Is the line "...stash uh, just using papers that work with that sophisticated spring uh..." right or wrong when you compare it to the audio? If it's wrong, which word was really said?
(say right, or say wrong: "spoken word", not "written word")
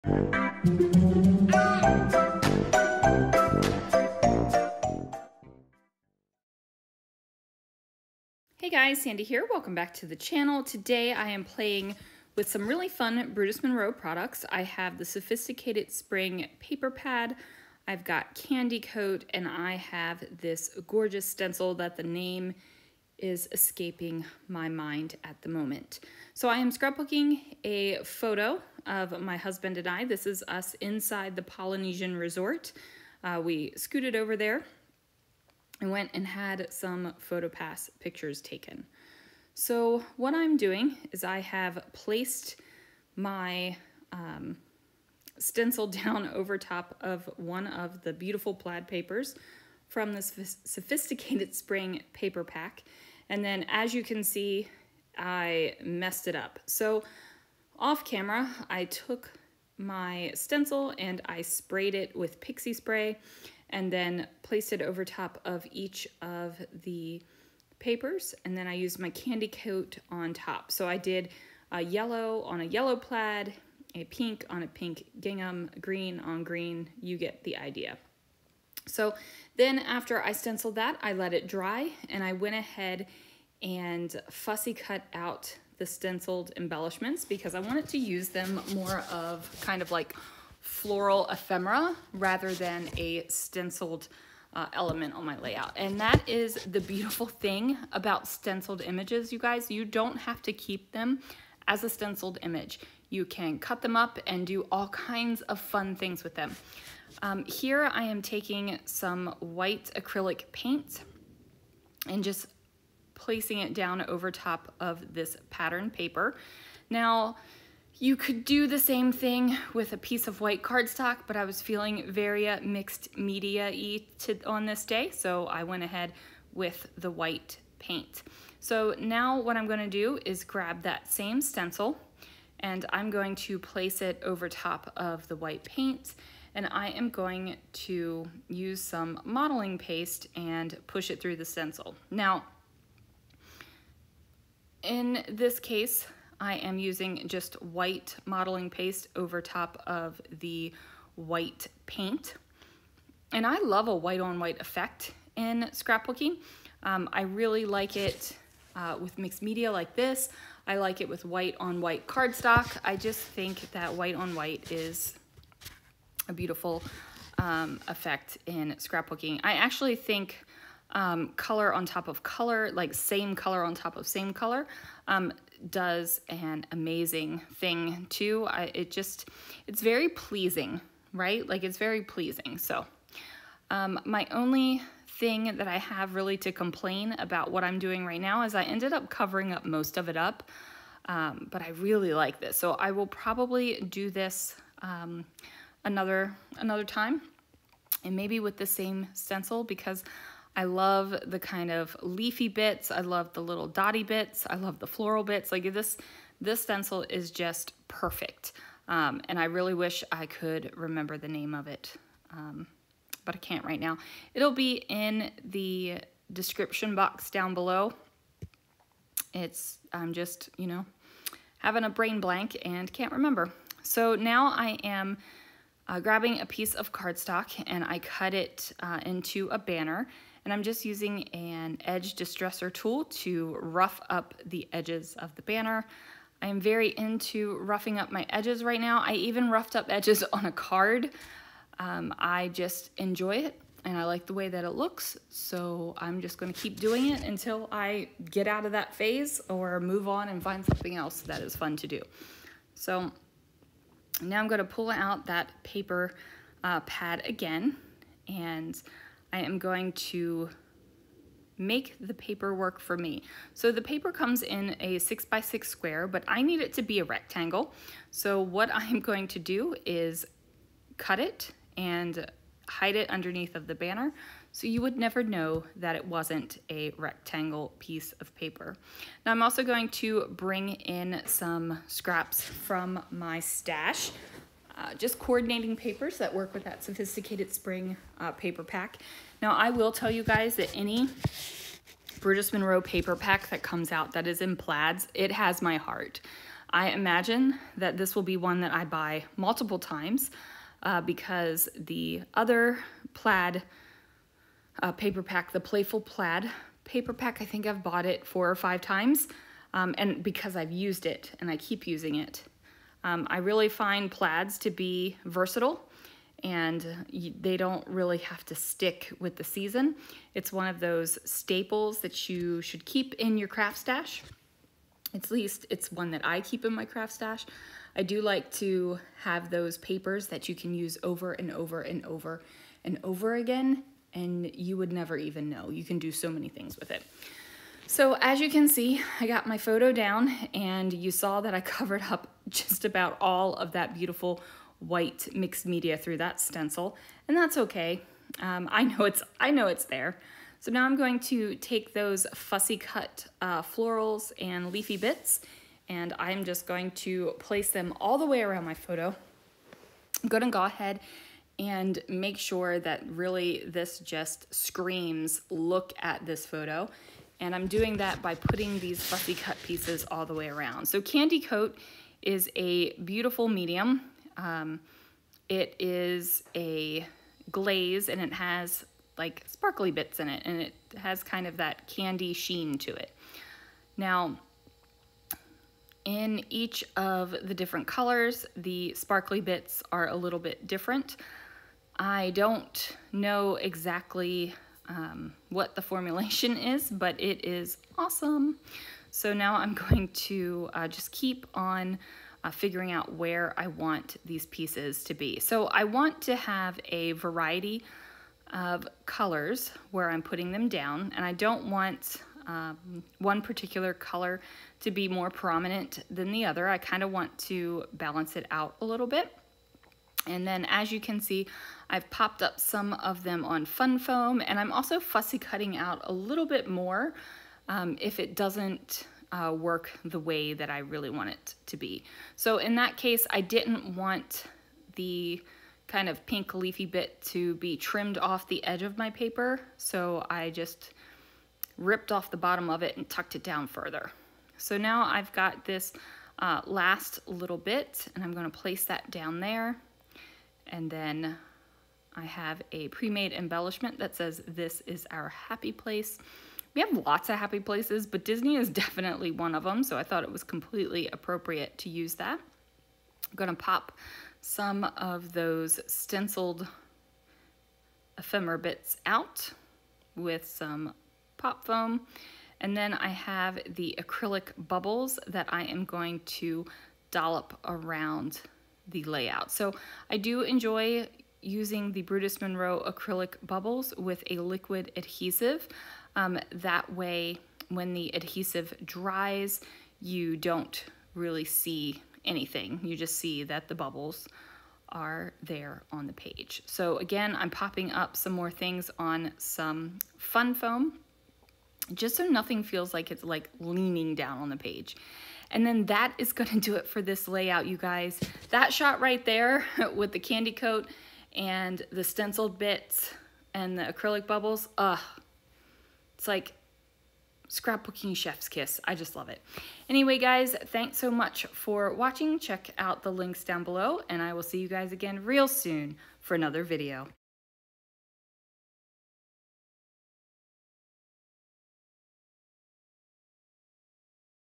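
wrong: "coordinating", not "using".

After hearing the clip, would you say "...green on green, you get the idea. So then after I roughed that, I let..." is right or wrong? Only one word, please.
wrong.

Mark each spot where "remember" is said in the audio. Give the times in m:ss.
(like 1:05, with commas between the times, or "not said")
3:30, 3:43.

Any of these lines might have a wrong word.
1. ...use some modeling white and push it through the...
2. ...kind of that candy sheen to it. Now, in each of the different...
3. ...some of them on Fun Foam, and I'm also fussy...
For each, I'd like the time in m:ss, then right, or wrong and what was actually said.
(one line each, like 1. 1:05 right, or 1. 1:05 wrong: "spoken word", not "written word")
1. 2:18 wrong: "paste", not "white"
2. 6:21 right
3. 7:02 right.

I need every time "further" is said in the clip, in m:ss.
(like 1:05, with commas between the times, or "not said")
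7:23.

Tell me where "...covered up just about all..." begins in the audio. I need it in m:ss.
5:41.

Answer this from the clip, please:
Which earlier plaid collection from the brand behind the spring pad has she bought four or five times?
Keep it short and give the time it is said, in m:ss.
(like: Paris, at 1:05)
Playful Plaid, at 5:05.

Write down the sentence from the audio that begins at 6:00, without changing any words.
I'm gonna go ahead and make sure that really this just screams, look at this photo.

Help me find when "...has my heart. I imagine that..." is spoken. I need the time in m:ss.
4:55.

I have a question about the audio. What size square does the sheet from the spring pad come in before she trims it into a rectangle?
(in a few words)
6 by 6.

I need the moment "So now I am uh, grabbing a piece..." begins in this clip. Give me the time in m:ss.
3:43.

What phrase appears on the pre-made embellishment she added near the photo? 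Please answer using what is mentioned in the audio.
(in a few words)
this is our happy place.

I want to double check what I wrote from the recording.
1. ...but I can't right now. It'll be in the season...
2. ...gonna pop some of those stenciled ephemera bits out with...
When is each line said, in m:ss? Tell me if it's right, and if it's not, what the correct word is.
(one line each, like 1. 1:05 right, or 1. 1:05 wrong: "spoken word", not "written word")
1. 3:33 wrong: "description", not "season"
2. 7:43 right.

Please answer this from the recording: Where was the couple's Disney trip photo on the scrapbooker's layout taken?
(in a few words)
Polynesian Resort.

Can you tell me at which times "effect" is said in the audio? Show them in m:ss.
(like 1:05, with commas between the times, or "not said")
2:34, 2:47.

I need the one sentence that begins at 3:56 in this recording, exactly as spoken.
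I am very into roughing up my edges right now.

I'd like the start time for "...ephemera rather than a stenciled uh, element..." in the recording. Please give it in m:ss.
1:31.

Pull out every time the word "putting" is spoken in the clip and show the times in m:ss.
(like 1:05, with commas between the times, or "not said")
6:08, 6:50.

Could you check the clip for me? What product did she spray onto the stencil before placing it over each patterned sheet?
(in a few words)
pixie spray.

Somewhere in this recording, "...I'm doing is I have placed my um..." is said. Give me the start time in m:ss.
0:40.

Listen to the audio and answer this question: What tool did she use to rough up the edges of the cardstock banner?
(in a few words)
edge distressor tool.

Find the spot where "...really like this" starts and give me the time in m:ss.
3:11.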